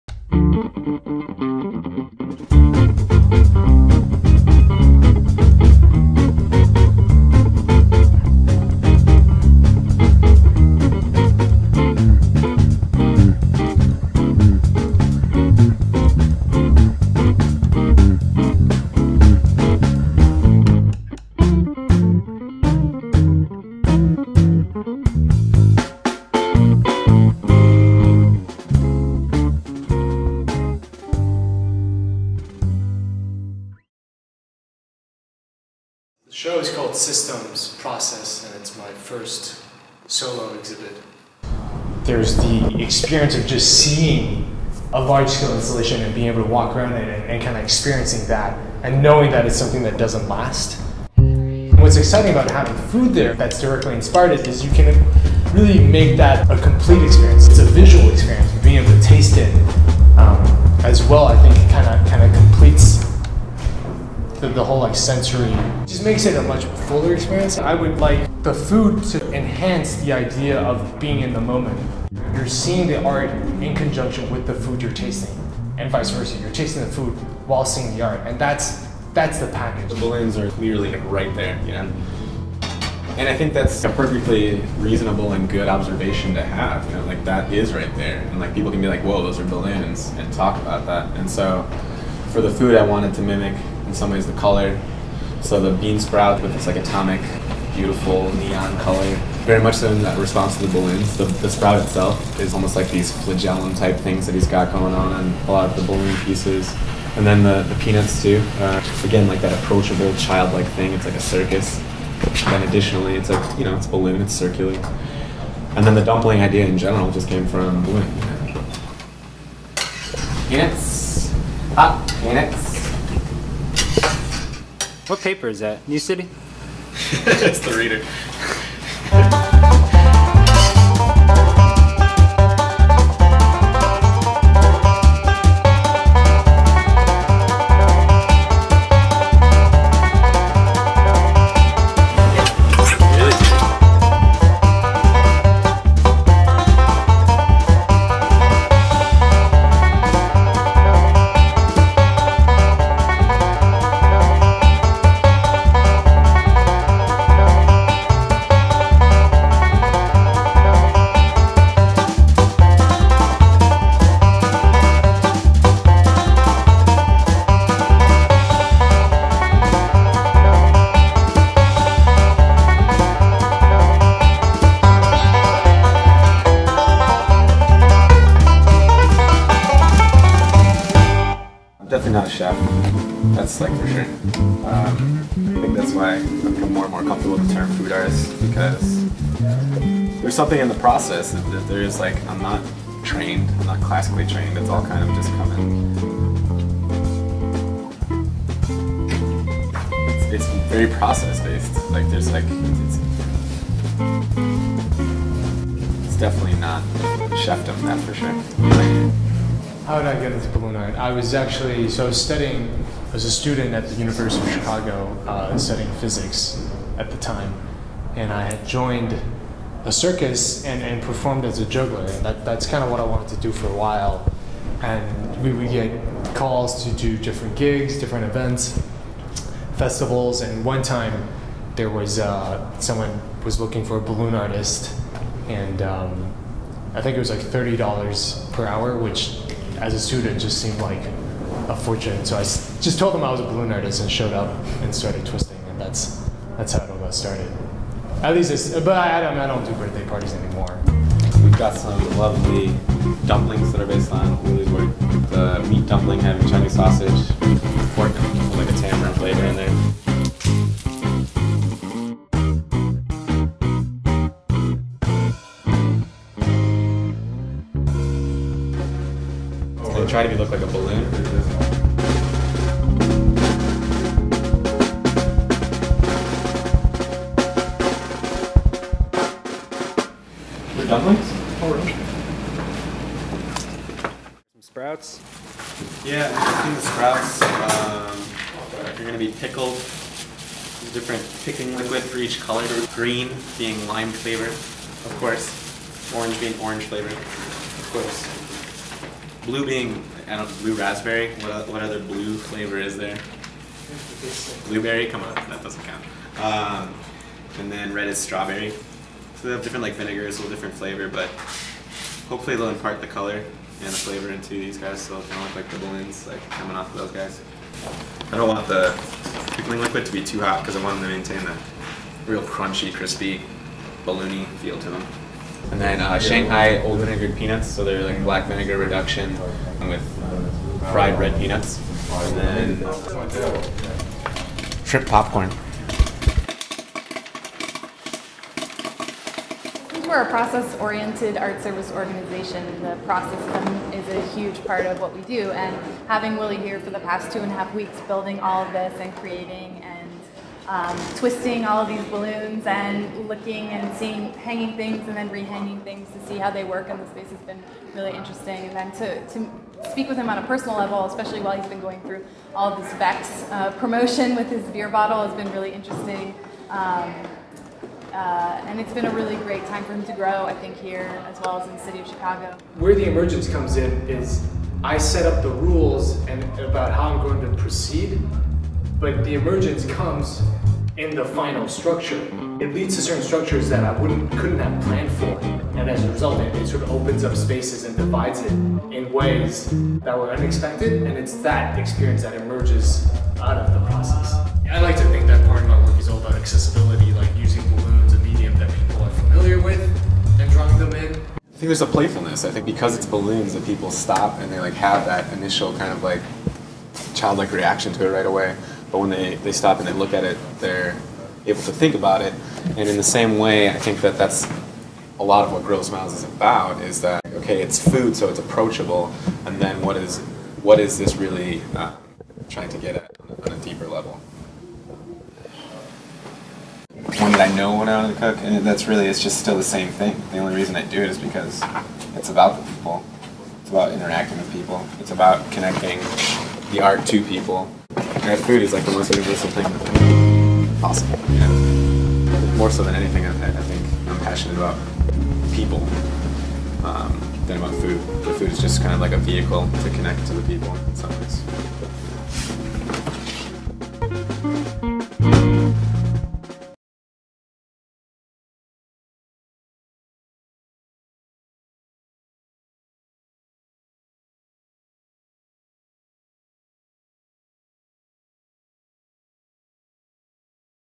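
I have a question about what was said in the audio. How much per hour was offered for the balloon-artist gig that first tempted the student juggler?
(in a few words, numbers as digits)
$30.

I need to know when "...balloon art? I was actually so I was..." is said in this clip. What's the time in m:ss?
3:30.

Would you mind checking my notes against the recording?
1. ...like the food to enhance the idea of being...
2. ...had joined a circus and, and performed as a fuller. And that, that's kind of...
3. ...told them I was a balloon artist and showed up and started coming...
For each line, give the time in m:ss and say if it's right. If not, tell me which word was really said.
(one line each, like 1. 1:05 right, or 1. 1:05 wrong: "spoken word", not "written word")
1. 1:07 right
2. 3:38 wrong: "juggler", not "fuller"
3. 4:02 wrong: "twisting", not "coming".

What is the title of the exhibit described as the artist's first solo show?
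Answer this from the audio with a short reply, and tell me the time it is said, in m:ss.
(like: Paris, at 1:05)
Systems Process, at 0:36.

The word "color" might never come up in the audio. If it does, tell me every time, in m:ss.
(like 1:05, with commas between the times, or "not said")
1:34, 1:38, 4:52, 5:13.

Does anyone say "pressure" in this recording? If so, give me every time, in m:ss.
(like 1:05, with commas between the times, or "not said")
not said.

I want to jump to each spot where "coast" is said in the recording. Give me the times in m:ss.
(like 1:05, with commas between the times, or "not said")
not said.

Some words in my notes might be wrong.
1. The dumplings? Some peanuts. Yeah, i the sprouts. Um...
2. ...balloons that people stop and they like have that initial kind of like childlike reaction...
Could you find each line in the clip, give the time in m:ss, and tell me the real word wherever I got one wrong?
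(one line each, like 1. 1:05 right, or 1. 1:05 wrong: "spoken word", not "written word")
1. 4:40 wrong: "sprouts", not "peanuts"
2. 6:43 right.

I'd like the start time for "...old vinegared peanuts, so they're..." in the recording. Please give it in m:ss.
5:26.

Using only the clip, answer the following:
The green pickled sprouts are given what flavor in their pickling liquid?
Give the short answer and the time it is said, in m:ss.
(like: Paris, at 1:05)
lime, at 4:53.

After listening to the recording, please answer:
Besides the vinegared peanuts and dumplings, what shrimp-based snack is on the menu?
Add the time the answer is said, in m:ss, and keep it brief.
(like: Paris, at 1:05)
shrimp popcorn, at 5:34.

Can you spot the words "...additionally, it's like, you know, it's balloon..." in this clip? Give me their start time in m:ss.
1:52.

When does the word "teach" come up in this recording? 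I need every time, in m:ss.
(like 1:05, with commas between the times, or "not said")
not said.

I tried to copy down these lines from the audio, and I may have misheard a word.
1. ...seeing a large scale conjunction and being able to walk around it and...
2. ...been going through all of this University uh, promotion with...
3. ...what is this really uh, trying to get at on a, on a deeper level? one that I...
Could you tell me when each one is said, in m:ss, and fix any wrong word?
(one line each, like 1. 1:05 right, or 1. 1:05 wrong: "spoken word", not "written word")
1. 0:43 wrong: "installation", not "conjunction"
2. 6:01 wrong: "Vex", not "University"
3. 7:00 right.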